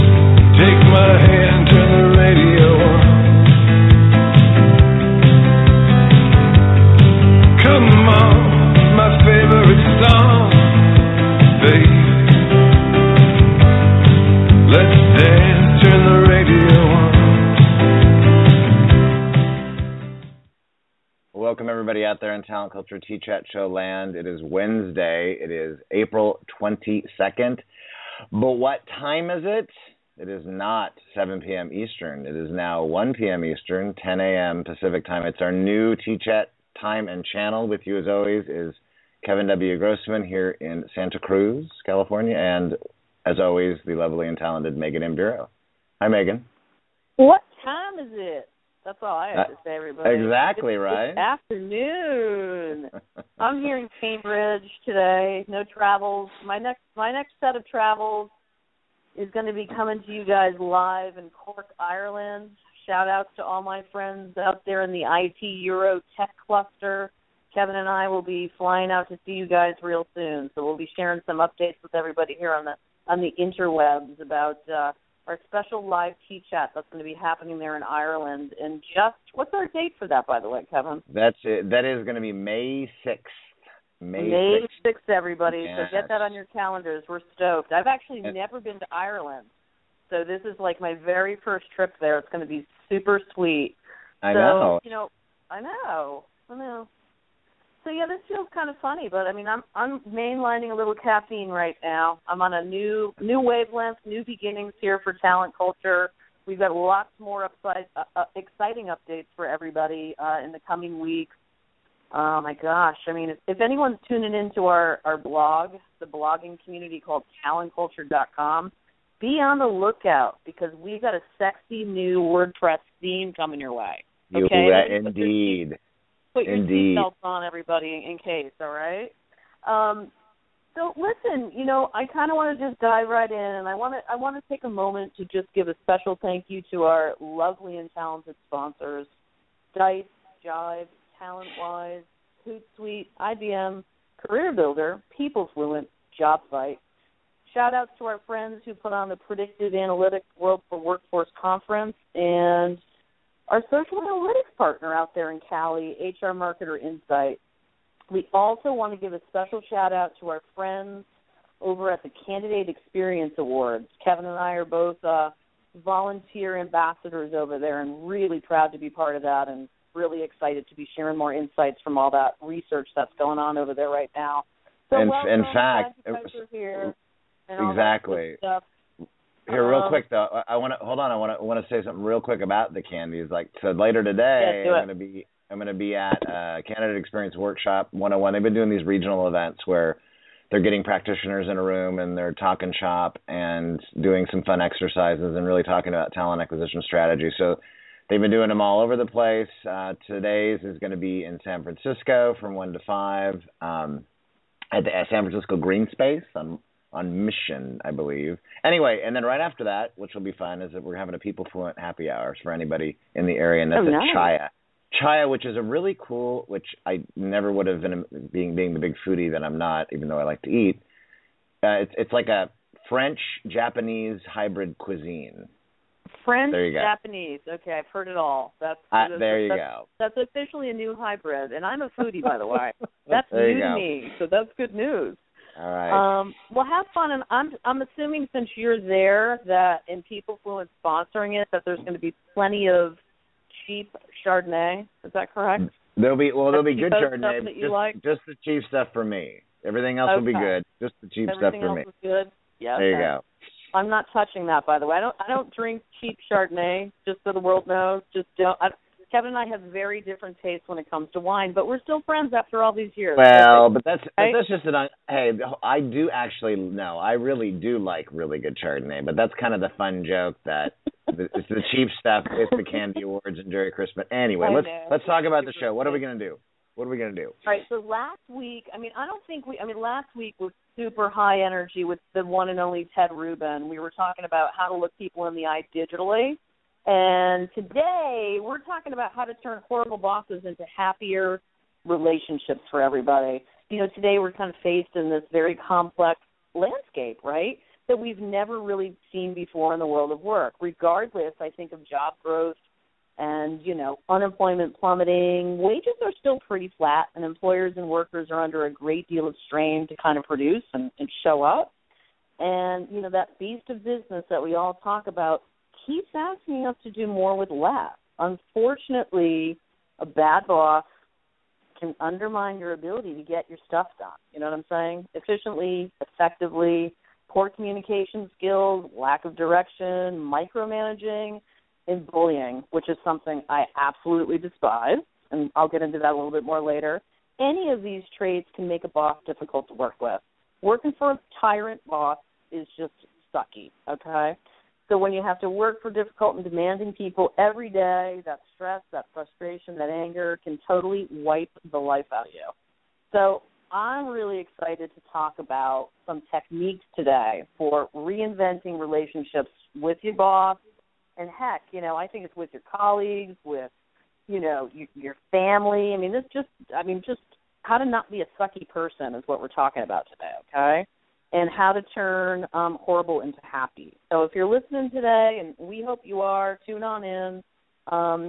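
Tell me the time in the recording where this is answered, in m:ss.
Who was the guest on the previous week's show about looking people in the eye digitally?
4:42.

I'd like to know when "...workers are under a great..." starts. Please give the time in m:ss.
5:07.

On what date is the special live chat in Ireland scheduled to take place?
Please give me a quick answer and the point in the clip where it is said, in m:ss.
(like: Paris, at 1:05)
May 6, at 1:22.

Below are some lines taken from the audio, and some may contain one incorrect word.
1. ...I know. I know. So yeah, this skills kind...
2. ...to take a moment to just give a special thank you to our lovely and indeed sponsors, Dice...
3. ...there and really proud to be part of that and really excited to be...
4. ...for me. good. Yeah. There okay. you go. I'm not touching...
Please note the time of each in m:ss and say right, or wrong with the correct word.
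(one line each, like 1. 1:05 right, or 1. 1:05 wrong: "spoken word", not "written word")
1. 1:35 wrong: "feels", not "skills"
2. 2:14 wrong: "talented", not "indeed"
3. 2:47 right
4. 4:11 right.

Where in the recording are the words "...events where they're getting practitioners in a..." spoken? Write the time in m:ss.
3:09.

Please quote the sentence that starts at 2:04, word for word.
Okay, you, uh, indeed put your seatbelts on, everybody, in case.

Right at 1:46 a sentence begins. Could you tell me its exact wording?
We've got lots more upside, uh, uh exciting updates for everybody uh, in the coming weeks.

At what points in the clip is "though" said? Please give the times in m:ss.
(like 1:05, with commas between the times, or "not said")
3:00, 3:40.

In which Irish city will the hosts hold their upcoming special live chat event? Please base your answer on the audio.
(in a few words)
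Cork.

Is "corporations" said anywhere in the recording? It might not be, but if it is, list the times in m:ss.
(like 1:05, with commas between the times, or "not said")
not said.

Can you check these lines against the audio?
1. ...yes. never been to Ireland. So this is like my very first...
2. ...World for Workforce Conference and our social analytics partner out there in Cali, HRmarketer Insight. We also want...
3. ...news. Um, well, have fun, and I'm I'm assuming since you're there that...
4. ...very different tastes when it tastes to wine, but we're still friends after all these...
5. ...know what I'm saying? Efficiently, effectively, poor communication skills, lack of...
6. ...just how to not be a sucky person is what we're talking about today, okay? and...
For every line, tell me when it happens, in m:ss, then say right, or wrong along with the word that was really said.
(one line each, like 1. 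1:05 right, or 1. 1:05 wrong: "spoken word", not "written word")
1. 1:28 right
2. 2:30 right
3. 3:54 right
4. 4:19 wrong: "comes", not "tastes"
5. 5:24 right
6. 6:07 right.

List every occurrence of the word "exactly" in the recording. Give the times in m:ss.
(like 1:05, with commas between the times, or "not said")
0:50, 2:57.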